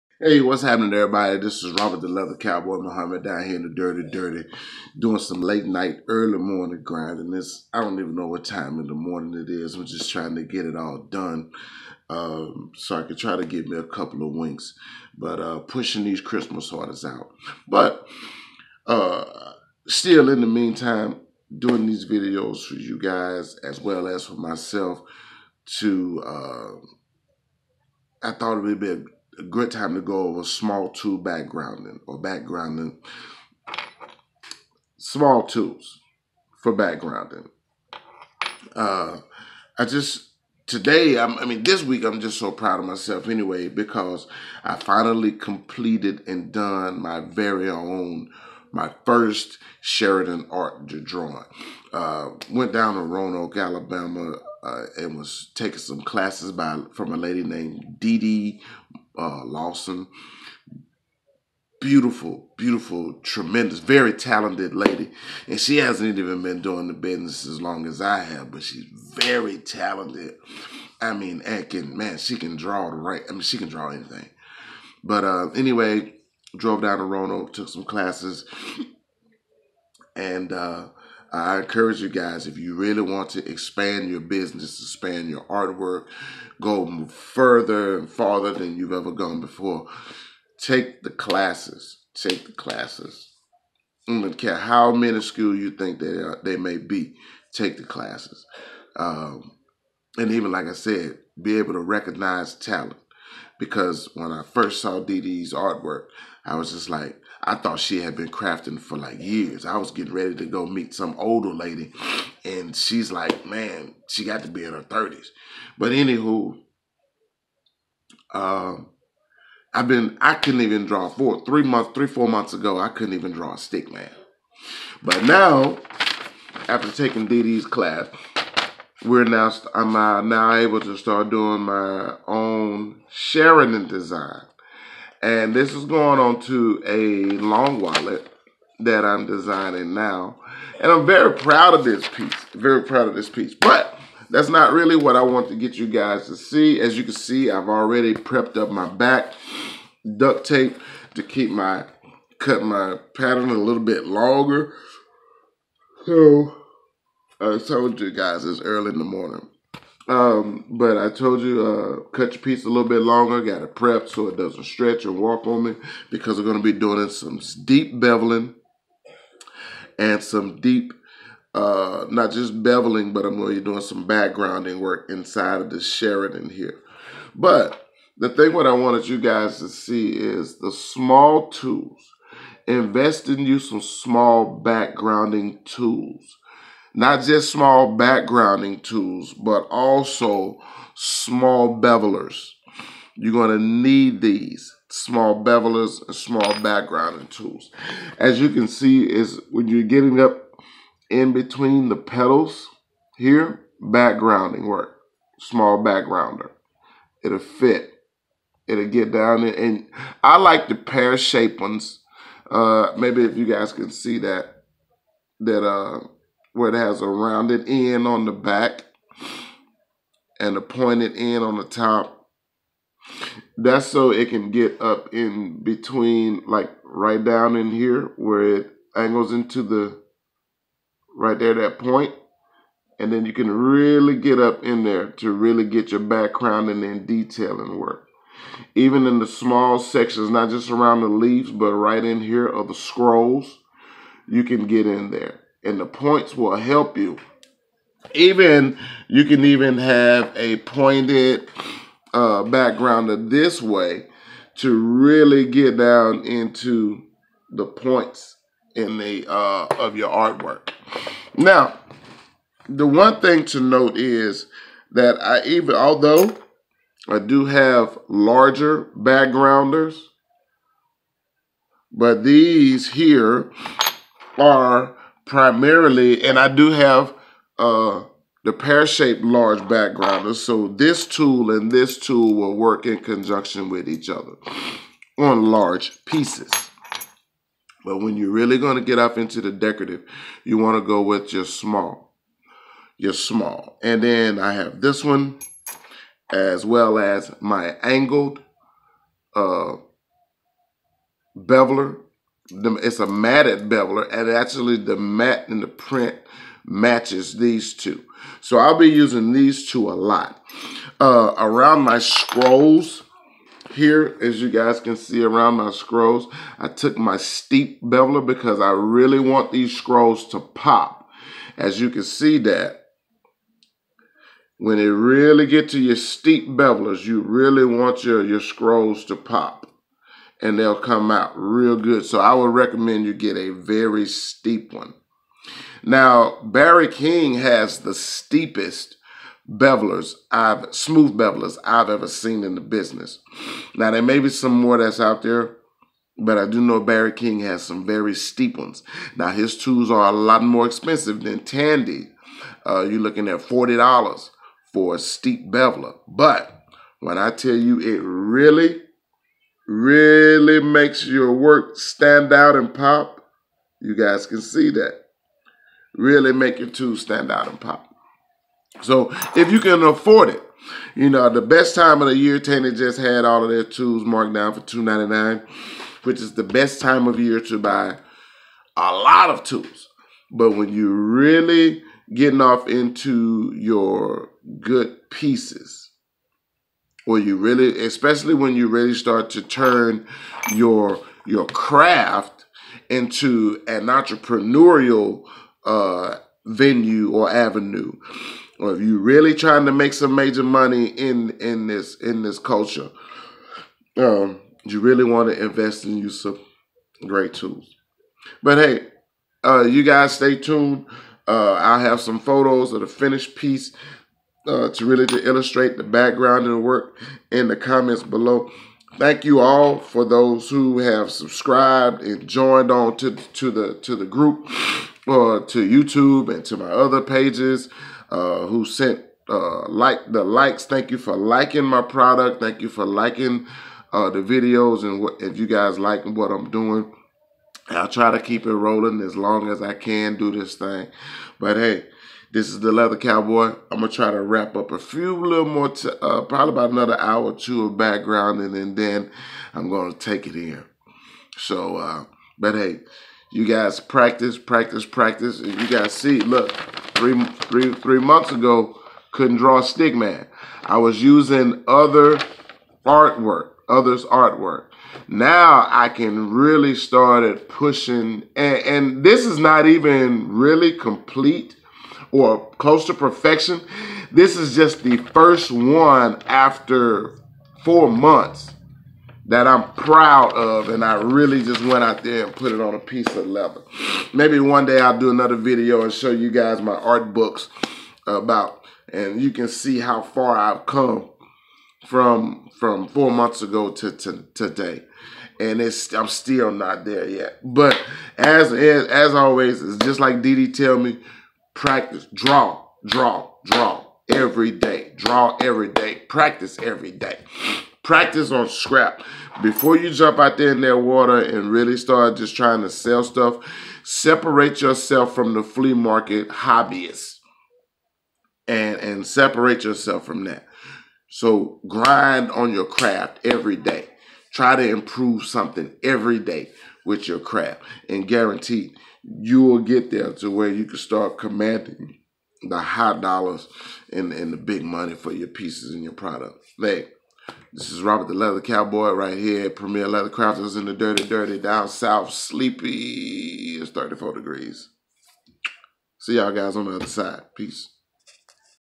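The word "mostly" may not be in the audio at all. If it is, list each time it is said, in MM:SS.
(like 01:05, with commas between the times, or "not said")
not said.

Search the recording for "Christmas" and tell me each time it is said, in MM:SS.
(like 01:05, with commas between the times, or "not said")
00:16.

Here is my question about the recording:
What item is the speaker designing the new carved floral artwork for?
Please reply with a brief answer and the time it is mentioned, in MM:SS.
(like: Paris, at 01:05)
A long wallet, at 02:17.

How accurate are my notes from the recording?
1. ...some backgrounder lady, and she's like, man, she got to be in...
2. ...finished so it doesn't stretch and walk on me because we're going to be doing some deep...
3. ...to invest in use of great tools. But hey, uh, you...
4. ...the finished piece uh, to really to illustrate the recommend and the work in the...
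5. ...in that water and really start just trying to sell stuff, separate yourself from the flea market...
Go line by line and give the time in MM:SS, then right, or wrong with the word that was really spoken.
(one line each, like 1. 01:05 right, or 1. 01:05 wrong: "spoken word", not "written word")
1. 01:50 wrong: "older", not "backgrounder"
2. 02:43 wrong: "prepped", not "finished"
3. 06:45 right
4. 06:52 wrong: "background", not "recommend"
5. 08:30 right.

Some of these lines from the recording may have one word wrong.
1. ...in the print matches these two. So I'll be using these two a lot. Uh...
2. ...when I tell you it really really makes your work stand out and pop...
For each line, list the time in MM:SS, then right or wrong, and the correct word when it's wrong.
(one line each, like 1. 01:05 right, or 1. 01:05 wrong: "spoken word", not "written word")
1. 05:05 right
2. 05:56 right.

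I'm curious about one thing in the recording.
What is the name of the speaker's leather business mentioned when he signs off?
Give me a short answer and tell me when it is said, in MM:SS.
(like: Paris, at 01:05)
Premier Leather Crafters, at 08:59.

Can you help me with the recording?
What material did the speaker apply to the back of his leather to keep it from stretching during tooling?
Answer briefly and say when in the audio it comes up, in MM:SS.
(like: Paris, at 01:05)
Duct tape, at 02:30.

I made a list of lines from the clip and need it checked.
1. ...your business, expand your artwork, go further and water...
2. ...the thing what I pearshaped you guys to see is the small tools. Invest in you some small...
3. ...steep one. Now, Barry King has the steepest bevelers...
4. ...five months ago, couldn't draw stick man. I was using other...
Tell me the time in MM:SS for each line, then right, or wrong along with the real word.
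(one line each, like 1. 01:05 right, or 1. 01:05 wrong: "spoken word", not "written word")
1. 01:24 wrong: "farther", not "water"
2. 02:58 wrong: "wanted", not "pearshaped"
3. 05:34 right
4. 07:37 wrong: "three", not "five".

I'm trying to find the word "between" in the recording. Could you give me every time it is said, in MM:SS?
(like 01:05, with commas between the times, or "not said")
03:21, 03:45.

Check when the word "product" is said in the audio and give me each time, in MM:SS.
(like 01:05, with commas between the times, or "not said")
07:11, 08:55.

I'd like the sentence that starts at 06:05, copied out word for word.
Really make your tools stand out and pop.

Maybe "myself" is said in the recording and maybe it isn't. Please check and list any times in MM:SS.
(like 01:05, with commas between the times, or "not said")
00:24, 00:42.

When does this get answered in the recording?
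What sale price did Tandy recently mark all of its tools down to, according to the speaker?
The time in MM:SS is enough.
06:14.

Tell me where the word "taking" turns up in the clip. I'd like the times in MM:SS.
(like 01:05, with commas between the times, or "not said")
00:55, 02:06.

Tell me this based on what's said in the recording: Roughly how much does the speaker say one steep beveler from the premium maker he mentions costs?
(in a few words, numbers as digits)
$40.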